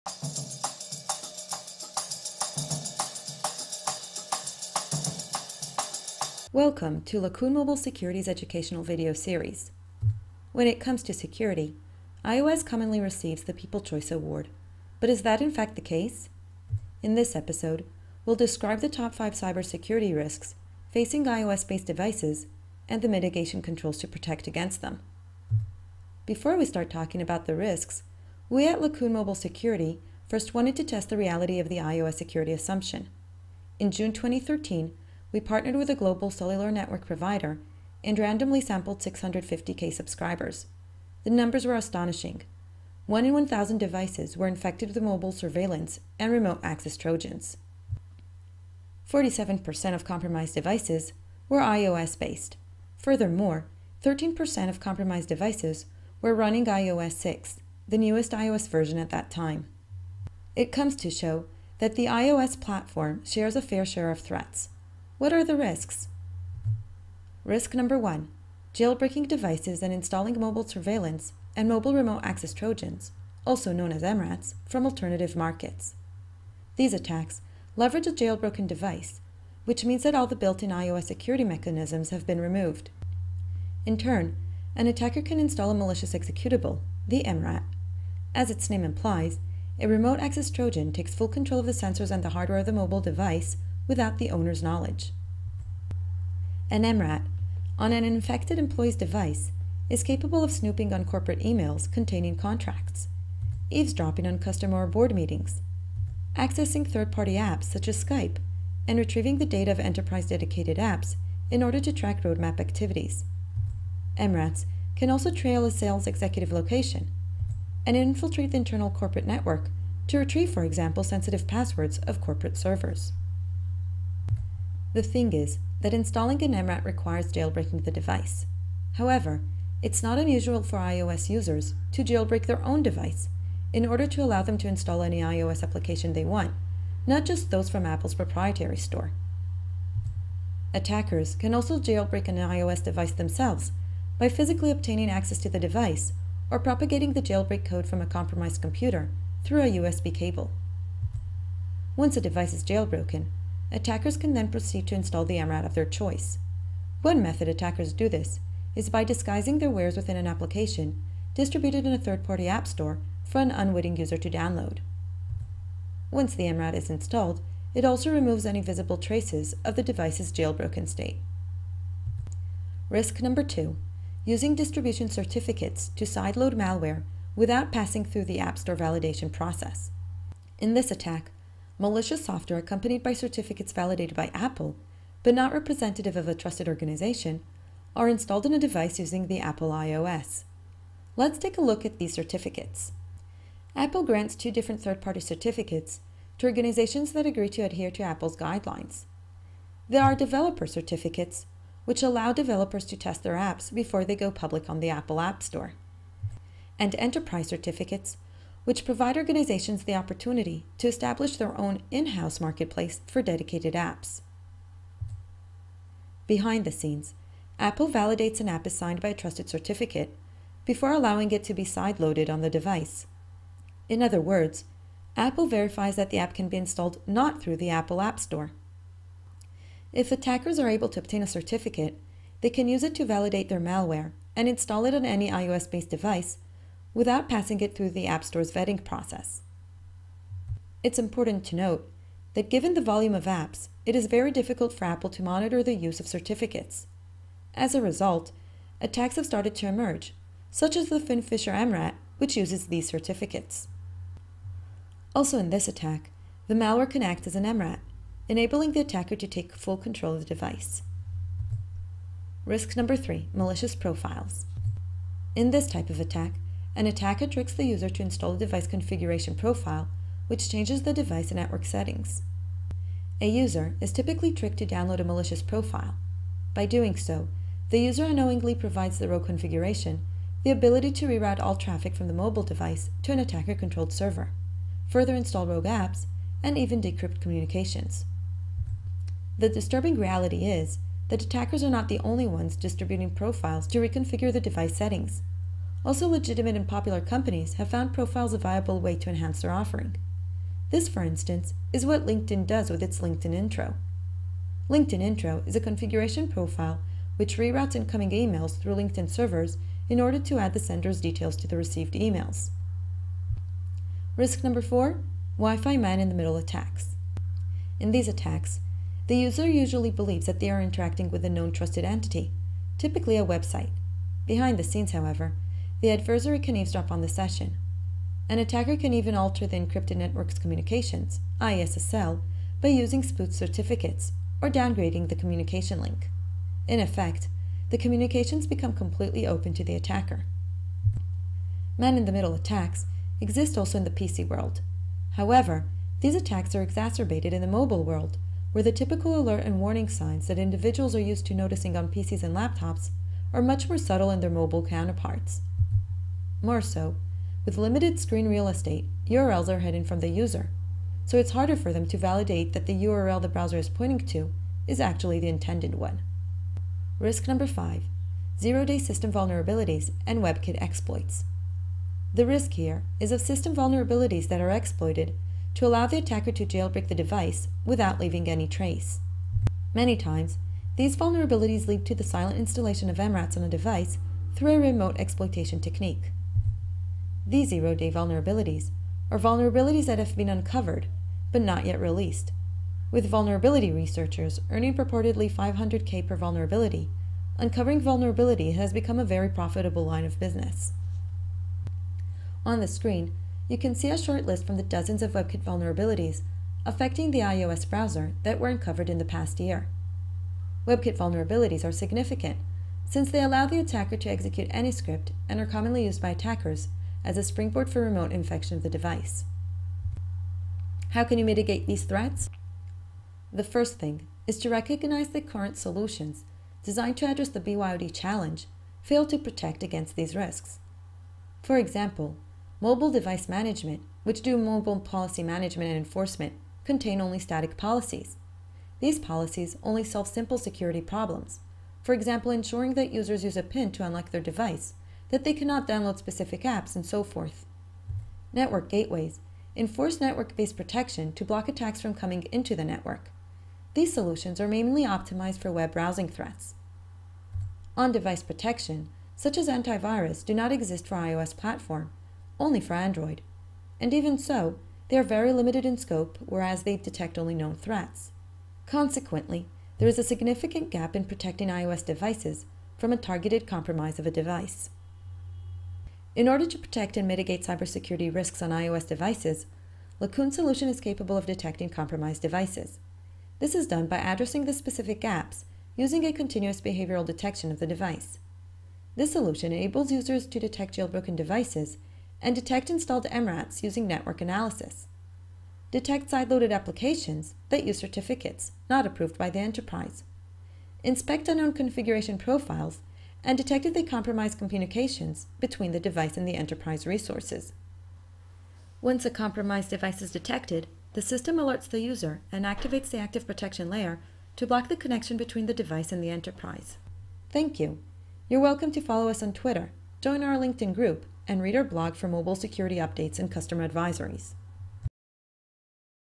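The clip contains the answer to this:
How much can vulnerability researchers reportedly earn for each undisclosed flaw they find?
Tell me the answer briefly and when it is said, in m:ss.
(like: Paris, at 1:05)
500k, at 6:35.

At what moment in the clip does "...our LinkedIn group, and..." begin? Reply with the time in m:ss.
8:40.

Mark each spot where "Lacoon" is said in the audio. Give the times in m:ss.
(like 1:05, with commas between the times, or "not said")
0:07, 0:28, 8:00.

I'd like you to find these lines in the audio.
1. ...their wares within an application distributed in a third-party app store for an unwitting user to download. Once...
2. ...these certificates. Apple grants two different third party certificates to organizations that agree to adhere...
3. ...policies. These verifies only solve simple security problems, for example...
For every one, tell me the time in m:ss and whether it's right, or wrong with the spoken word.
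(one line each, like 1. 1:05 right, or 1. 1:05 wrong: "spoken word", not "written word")
1. 2:39 right
2. 3:11 right
3. 7:17 wrong: "policies", not "verifies".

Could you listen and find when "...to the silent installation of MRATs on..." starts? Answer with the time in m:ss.
6:21.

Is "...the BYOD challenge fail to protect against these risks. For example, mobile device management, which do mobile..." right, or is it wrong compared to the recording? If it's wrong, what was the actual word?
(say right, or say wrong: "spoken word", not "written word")
right.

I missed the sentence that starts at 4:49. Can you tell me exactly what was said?
The disturbing reality is that attackers are not the only ones distributing profiles to reconfigure the device settings.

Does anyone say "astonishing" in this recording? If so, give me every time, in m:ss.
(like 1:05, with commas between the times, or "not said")
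0:41.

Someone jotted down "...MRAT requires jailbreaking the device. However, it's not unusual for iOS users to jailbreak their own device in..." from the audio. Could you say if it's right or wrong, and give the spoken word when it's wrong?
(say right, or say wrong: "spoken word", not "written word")
right.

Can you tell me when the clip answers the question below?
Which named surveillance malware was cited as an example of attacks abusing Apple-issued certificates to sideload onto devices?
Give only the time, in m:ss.
4:10.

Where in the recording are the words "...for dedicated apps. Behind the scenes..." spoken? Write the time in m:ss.
3:33.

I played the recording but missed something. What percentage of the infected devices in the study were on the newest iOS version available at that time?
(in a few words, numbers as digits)
13%.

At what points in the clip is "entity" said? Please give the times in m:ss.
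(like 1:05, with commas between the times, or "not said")
5:21.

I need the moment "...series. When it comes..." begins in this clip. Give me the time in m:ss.
0:09.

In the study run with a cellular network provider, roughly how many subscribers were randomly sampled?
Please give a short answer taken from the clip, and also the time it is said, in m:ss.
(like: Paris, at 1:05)
650K, at 0:38.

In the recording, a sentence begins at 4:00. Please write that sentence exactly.
It's important to note that given the volume of apps, it is very difficult for Apple to monitor the use of certificates.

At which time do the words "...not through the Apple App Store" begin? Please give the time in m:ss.
3:47.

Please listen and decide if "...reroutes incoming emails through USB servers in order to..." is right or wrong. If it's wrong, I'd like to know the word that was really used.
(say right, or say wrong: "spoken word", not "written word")
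wrong: "LinkedIn", not "USB".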